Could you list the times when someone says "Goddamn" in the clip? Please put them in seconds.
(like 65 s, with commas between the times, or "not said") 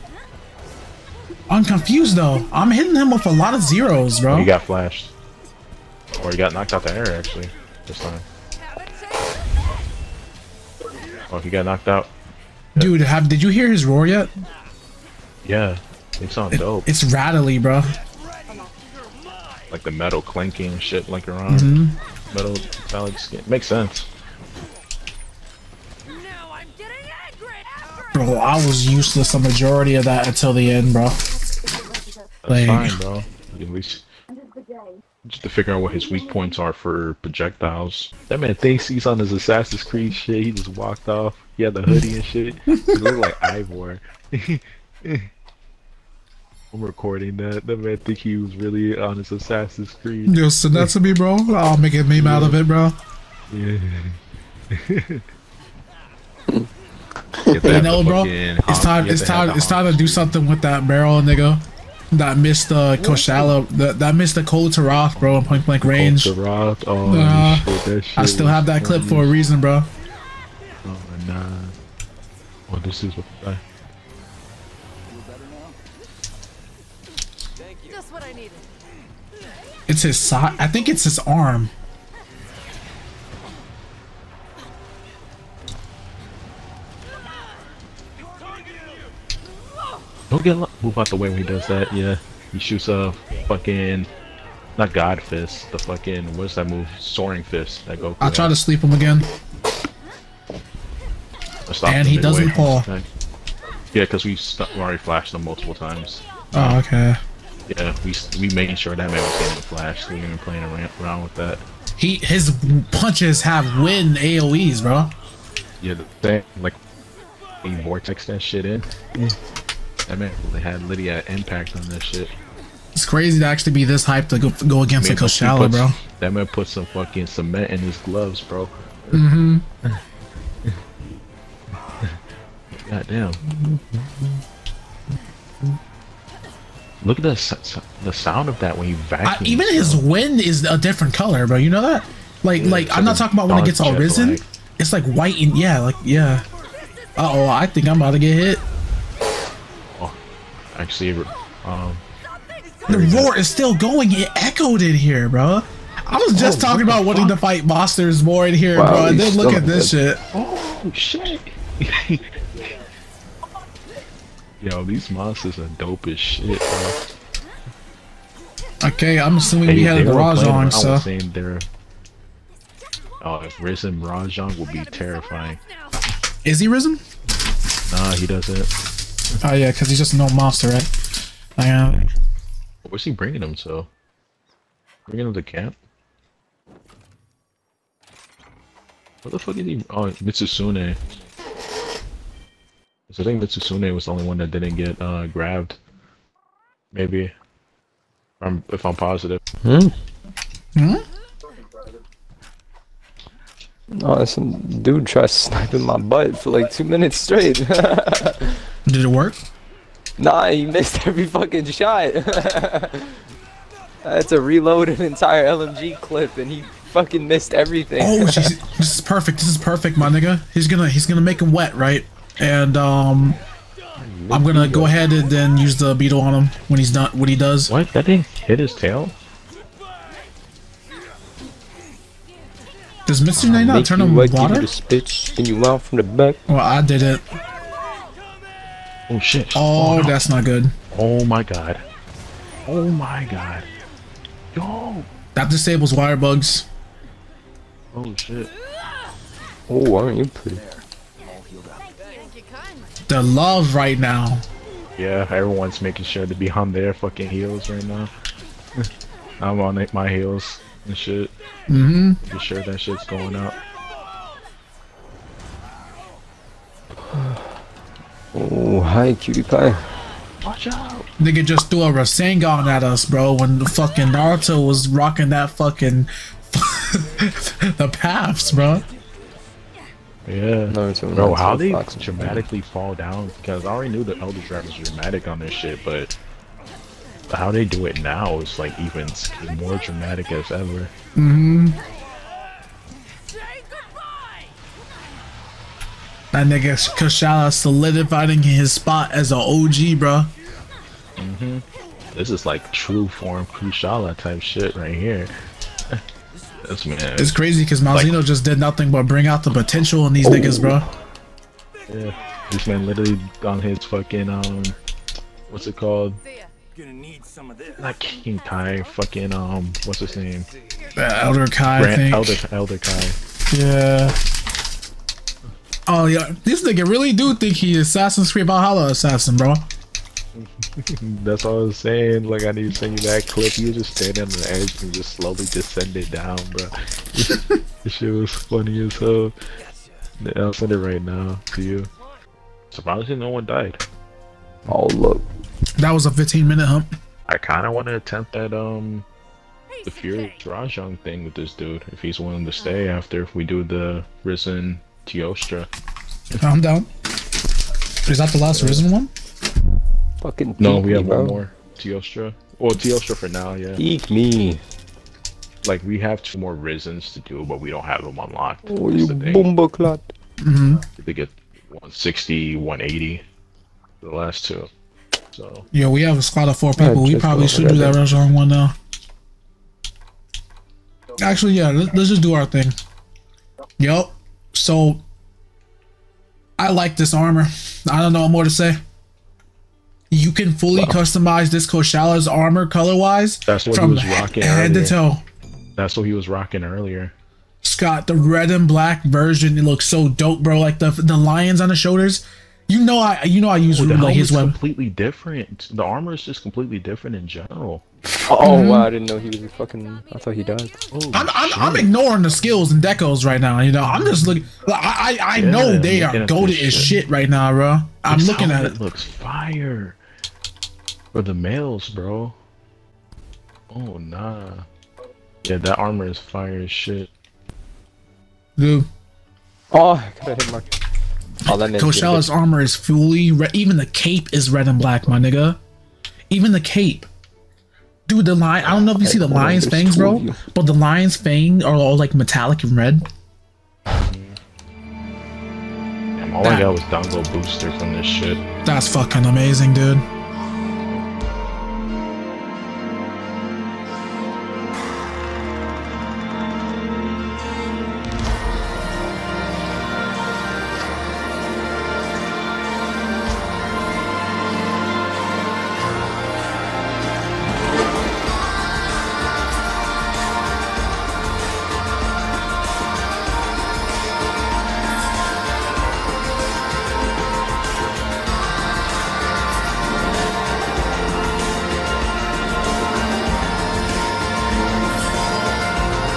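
132 s.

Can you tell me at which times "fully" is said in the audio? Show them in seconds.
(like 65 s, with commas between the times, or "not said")
390 s, 432 s.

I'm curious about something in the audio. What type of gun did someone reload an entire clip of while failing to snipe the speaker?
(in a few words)
LMG.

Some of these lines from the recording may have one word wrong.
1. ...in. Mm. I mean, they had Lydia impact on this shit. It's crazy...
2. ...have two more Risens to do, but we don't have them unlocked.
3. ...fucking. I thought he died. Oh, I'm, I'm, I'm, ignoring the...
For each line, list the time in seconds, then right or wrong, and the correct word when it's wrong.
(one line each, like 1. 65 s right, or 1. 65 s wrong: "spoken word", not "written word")
1. 118 s right
2. 365 s right
3. 409 s right.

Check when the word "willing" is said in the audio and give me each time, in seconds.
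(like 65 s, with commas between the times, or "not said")
352 s.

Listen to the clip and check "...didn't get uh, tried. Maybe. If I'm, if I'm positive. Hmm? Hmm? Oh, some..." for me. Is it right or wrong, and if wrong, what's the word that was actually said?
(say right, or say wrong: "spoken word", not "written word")
wrong: "grabbed", not "tried".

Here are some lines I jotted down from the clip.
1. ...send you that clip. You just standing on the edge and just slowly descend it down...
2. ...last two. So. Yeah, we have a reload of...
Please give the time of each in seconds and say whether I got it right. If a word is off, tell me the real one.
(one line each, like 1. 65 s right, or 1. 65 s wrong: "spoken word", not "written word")
1. 332 s right
2. 374 s wrong: "squad", not "reload".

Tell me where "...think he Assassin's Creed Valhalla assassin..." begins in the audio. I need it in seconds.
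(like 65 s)
327 s.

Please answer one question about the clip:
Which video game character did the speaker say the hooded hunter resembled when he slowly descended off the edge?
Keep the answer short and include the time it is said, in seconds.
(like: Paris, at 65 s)
Eivor, at 43 s.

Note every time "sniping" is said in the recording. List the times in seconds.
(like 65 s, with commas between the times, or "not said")
205 s.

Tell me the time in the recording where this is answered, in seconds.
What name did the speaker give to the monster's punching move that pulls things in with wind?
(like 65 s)
97 s.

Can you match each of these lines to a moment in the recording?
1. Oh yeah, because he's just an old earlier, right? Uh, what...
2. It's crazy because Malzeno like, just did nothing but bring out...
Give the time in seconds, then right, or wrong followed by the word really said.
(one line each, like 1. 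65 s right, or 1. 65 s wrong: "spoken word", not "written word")
1. 179 s wrong: "monster", not "earlier"
2. 307 s right.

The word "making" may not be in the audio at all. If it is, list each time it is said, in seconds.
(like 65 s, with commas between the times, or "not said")
108 s, 255 s.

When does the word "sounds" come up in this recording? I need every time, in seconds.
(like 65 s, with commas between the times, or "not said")
16 s, 138 s.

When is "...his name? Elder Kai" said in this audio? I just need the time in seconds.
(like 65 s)
319 s.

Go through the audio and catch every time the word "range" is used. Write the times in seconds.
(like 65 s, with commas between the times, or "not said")
65 s.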